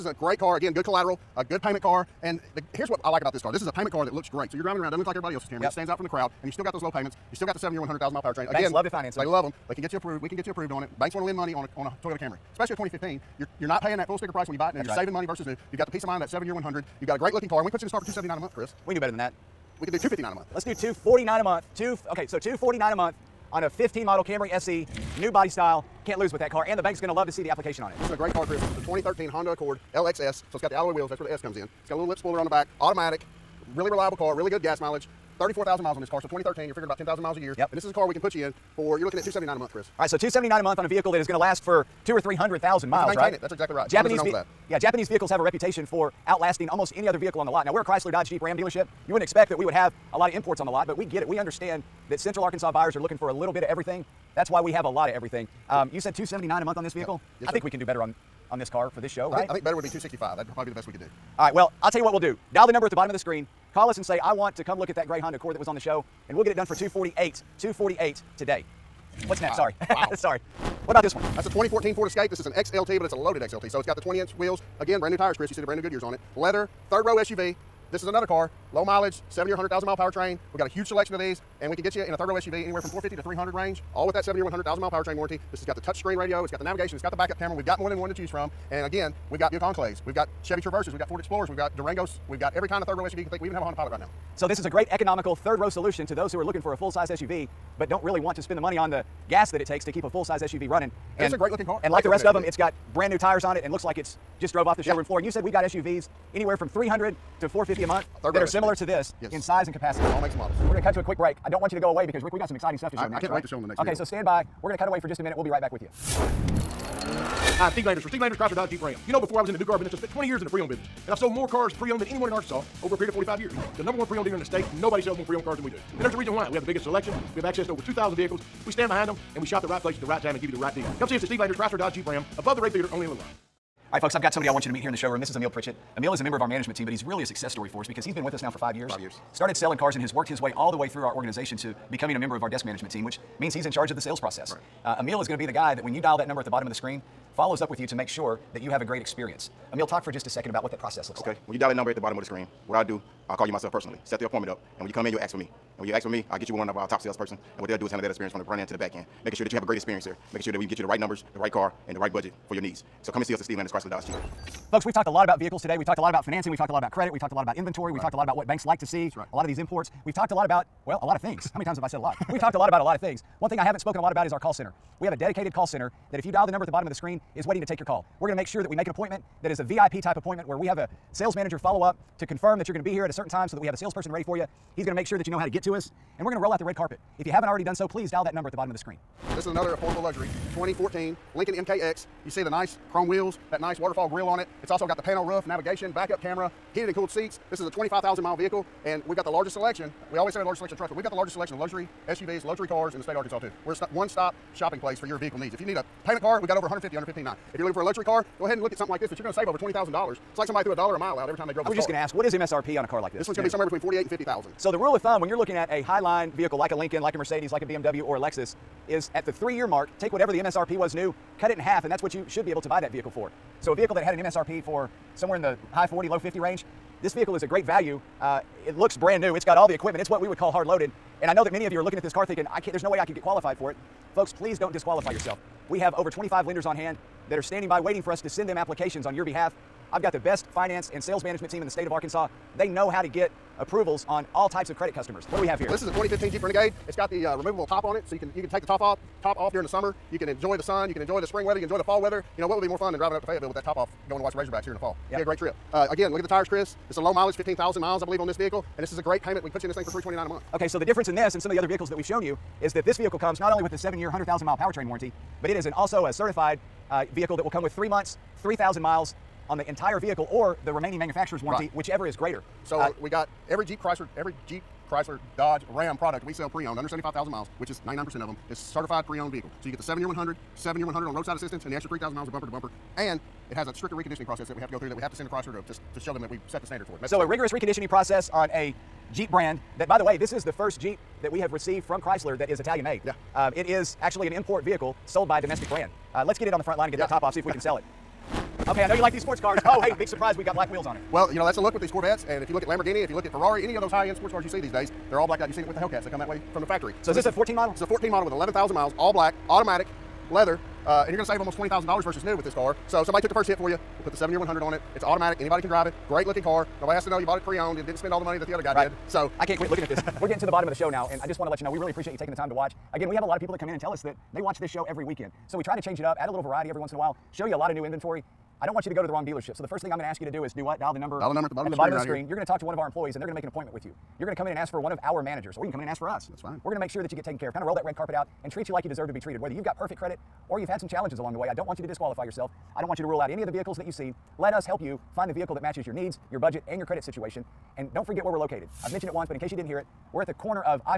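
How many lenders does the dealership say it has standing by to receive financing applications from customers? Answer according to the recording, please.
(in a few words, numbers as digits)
25.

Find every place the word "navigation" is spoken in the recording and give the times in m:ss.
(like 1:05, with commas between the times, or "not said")
1:26, 3:15.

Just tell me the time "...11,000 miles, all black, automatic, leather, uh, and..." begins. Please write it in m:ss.
5:08.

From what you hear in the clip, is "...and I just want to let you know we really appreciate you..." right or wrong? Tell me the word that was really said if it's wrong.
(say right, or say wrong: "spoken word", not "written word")
right.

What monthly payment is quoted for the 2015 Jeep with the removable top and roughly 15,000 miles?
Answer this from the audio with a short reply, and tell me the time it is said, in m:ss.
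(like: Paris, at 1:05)
$329, at 4:19.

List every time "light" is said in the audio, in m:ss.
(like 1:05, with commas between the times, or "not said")
not said.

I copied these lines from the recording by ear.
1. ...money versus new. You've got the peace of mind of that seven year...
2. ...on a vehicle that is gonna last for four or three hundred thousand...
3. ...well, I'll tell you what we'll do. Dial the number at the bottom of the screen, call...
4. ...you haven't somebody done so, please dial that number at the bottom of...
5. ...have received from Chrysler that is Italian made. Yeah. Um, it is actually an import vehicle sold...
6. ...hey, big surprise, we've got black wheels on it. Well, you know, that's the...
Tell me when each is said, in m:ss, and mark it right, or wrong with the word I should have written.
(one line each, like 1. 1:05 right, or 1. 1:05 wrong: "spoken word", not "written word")
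1. 0:15 right
2. 0:40 wrong: "two", not "four"
3. 1:01 right
4. 3:07 wrong: "already", not "somebody"
5. 4:51 right
6. 4:59 right.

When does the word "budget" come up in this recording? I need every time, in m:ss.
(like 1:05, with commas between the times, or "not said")
2:42, 5:46.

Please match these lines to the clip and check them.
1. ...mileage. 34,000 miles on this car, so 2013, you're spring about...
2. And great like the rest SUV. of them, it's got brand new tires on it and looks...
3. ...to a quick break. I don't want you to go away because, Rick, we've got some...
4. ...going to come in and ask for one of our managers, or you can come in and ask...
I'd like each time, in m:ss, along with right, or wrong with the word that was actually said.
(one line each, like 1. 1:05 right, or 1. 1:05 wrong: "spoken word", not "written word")
1. 0:34 wrong: "figuring", not "spring"
2. 1:41 right
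3. 1:50 right
4. 5:34 right.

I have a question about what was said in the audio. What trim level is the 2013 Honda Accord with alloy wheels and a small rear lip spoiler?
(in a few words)
LXS.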